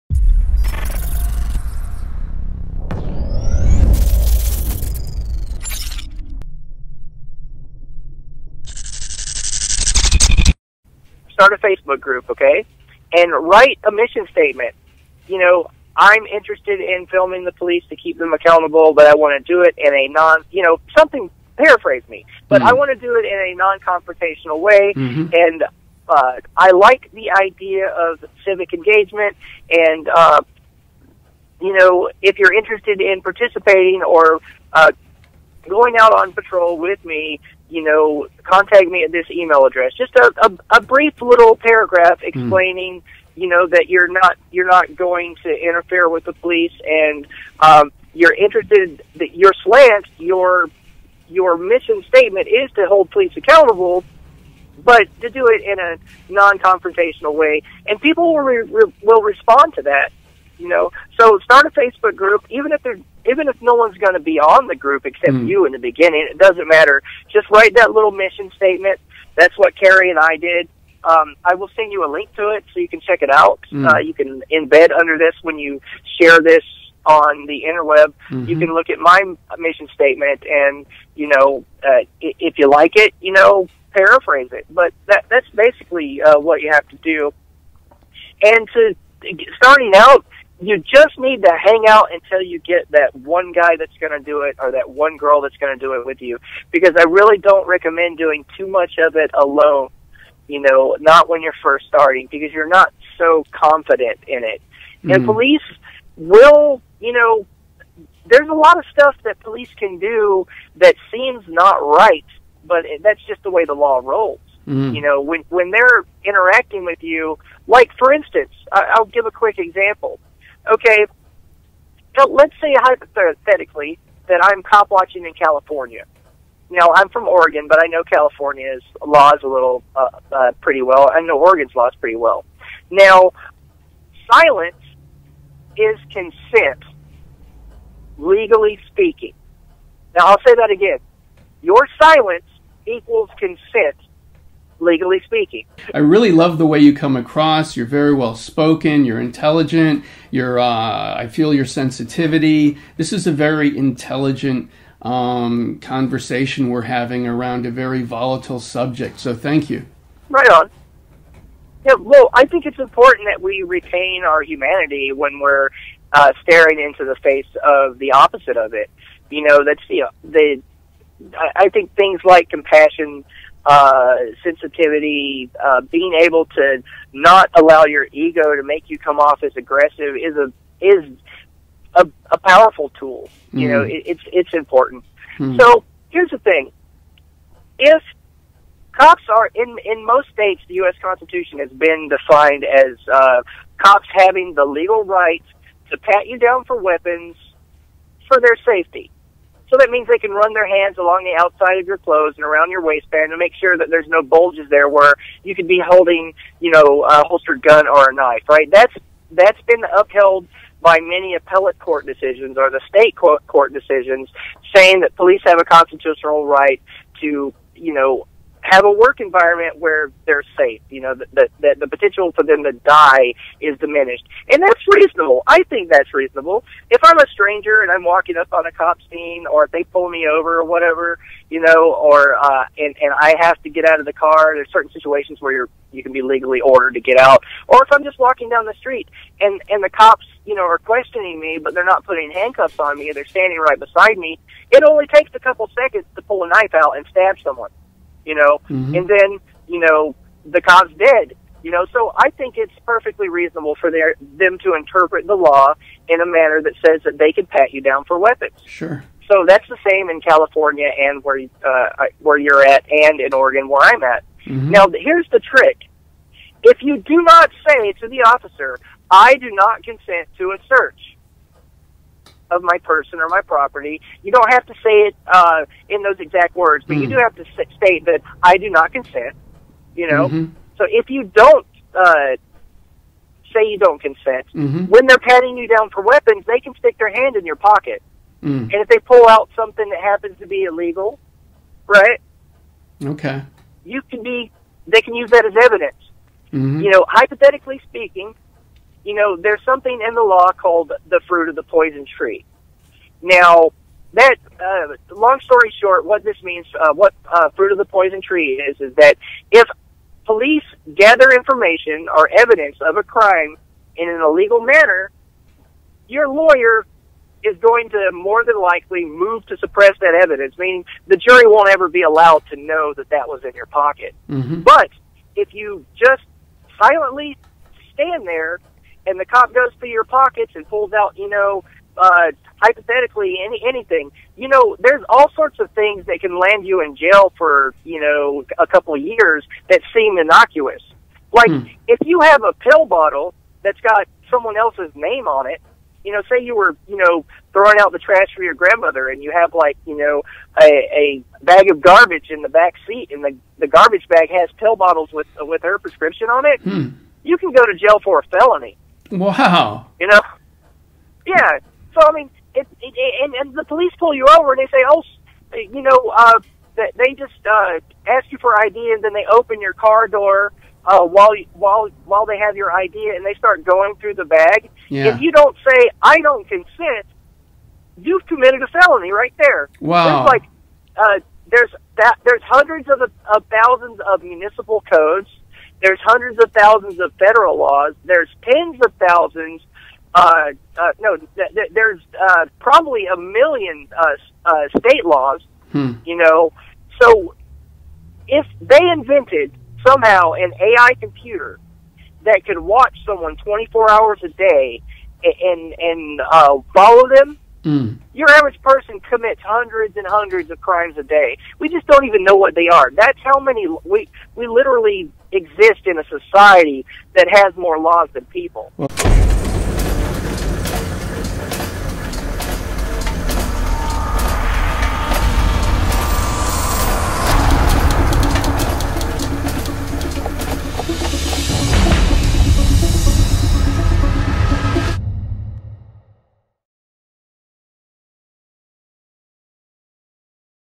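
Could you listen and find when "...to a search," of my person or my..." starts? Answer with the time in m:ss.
4:30.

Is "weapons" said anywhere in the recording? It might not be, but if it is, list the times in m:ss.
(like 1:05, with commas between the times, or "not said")
3:16, 4:18, 4:46.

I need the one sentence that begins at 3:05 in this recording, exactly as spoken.
mm So here's the thing: if cops are in in most states, the U.S.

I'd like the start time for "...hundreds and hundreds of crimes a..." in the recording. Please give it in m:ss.
6:49.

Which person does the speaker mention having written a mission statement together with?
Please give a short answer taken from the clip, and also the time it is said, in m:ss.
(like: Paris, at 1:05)
Carrie, at 1:09.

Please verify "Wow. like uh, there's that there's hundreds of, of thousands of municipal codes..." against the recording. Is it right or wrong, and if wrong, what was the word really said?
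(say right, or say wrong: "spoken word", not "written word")
right.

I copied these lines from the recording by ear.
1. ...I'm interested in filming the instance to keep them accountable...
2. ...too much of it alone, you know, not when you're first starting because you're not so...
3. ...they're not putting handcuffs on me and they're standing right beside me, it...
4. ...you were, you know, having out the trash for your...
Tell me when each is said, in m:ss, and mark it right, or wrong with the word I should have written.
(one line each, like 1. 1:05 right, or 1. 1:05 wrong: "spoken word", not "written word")
1. 0:15 wrong: "police", not "instance"
2. 1:38 right
3. 4:01 right
4. 5:46 wrong: "throwing", not "having".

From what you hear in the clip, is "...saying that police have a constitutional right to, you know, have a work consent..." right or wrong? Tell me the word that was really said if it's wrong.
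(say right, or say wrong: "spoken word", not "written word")
wrong: "environment", not "consent".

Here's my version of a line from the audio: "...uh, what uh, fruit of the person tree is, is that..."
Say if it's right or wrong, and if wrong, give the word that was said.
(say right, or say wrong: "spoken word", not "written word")
wrong: "poison", not "person".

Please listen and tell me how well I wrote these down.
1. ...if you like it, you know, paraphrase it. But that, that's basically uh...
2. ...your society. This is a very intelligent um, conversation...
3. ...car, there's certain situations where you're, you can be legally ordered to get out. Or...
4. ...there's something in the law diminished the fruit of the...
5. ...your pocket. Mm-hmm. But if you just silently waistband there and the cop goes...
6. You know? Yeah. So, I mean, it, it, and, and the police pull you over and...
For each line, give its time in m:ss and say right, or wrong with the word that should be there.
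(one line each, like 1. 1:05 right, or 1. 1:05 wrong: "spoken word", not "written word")
1. 1:22 right
2. 2:31 wrong: "sensitivity", not "society"
3. 3:54 right
4. 4:59 wrong: "called", not "diminished"
5. 5:23 wrong: "stand", not "waistband"
6. 5:59 right.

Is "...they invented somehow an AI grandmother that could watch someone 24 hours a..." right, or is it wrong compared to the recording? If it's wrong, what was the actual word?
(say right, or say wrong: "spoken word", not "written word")
wrong: "computer", not "grandmother".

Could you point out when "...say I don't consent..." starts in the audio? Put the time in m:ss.
6:15.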